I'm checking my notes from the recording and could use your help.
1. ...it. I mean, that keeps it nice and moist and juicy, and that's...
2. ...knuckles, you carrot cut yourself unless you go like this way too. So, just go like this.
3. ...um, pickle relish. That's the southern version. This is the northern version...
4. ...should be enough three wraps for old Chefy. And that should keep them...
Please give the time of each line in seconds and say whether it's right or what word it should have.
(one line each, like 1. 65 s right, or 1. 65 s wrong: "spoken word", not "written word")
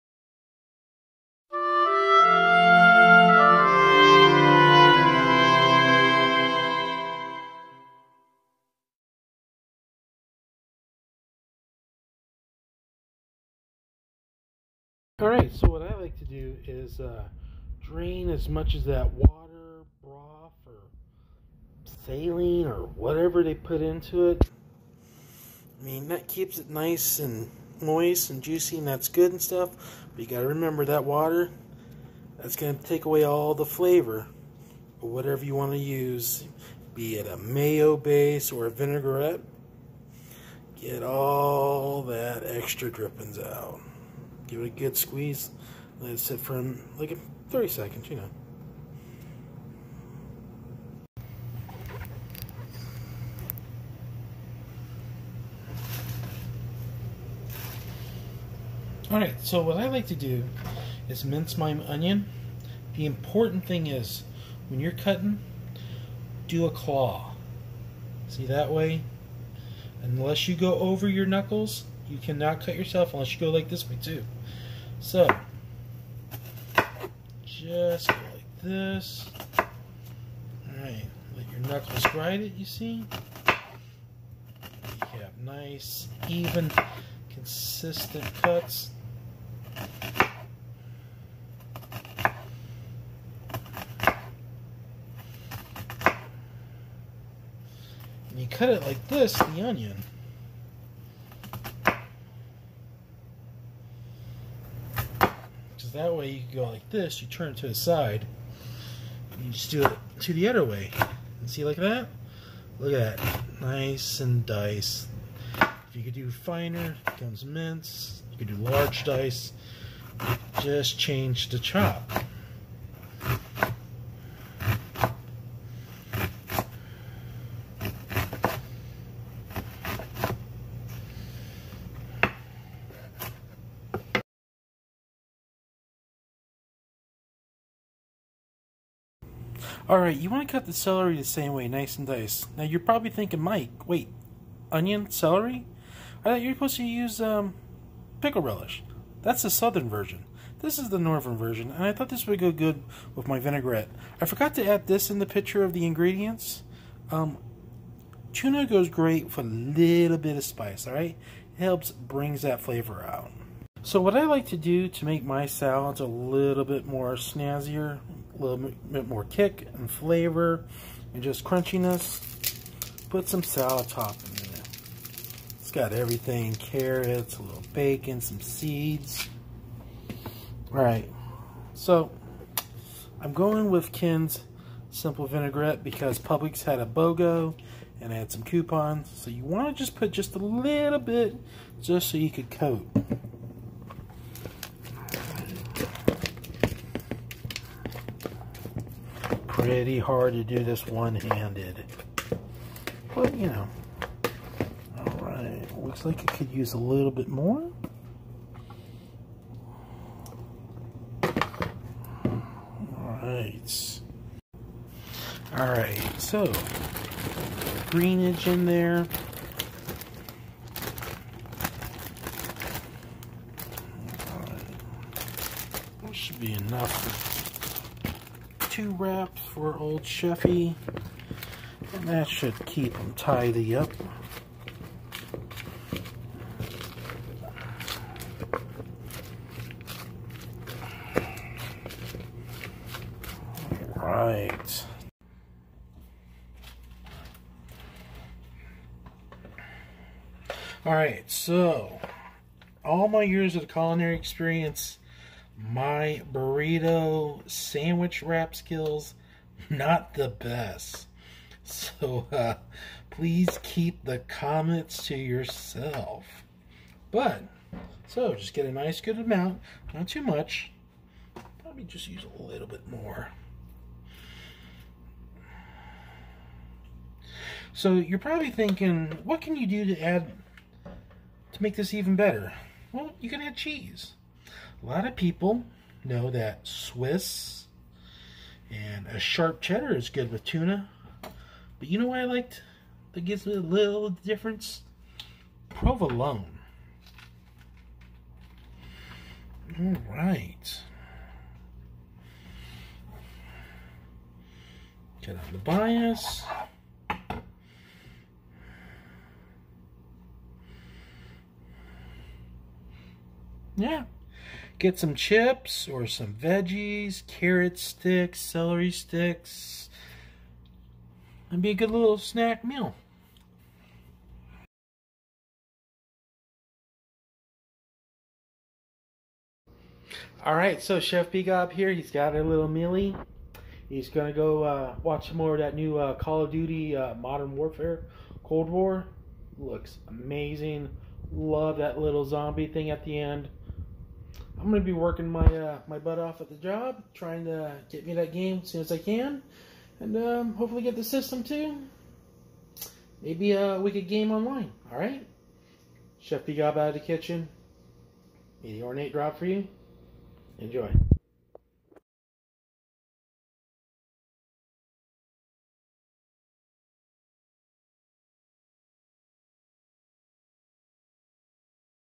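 1. 24 s right
2. 71 s wrong: "cannot", not "carrot"
3. 147 s right
4. 226 s wrong: "two", not "three".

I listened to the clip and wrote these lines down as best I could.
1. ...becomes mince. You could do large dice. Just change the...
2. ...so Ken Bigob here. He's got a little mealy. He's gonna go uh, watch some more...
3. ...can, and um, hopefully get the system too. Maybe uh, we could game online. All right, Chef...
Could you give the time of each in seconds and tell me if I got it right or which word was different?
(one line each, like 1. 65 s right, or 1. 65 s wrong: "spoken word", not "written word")
1. 117 s right
2. 330 s wrong: "Chef", not "Ken"
3. 348 s right.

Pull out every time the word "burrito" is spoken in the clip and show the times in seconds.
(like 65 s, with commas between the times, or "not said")
256 s.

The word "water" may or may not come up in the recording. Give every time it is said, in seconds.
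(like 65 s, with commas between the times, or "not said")
19 s, 31 s.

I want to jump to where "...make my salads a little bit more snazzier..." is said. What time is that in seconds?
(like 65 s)
165 s.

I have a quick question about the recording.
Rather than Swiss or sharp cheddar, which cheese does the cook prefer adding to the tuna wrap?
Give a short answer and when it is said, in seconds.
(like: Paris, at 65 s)
Provolone, at 295 s.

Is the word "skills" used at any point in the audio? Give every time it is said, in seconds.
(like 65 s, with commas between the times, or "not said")
258 s.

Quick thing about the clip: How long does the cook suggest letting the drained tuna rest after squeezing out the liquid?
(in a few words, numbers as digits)
30 seconds.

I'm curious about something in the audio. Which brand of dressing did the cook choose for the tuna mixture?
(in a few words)
Ken's Simple Vinaigrette.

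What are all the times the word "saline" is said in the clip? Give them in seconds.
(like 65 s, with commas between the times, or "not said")
22 s.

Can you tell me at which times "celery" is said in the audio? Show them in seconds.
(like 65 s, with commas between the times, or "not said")
140 s, 145 s, 318 s.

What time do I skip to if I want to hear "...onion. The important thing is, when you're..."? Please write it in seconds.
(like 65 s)
61 s.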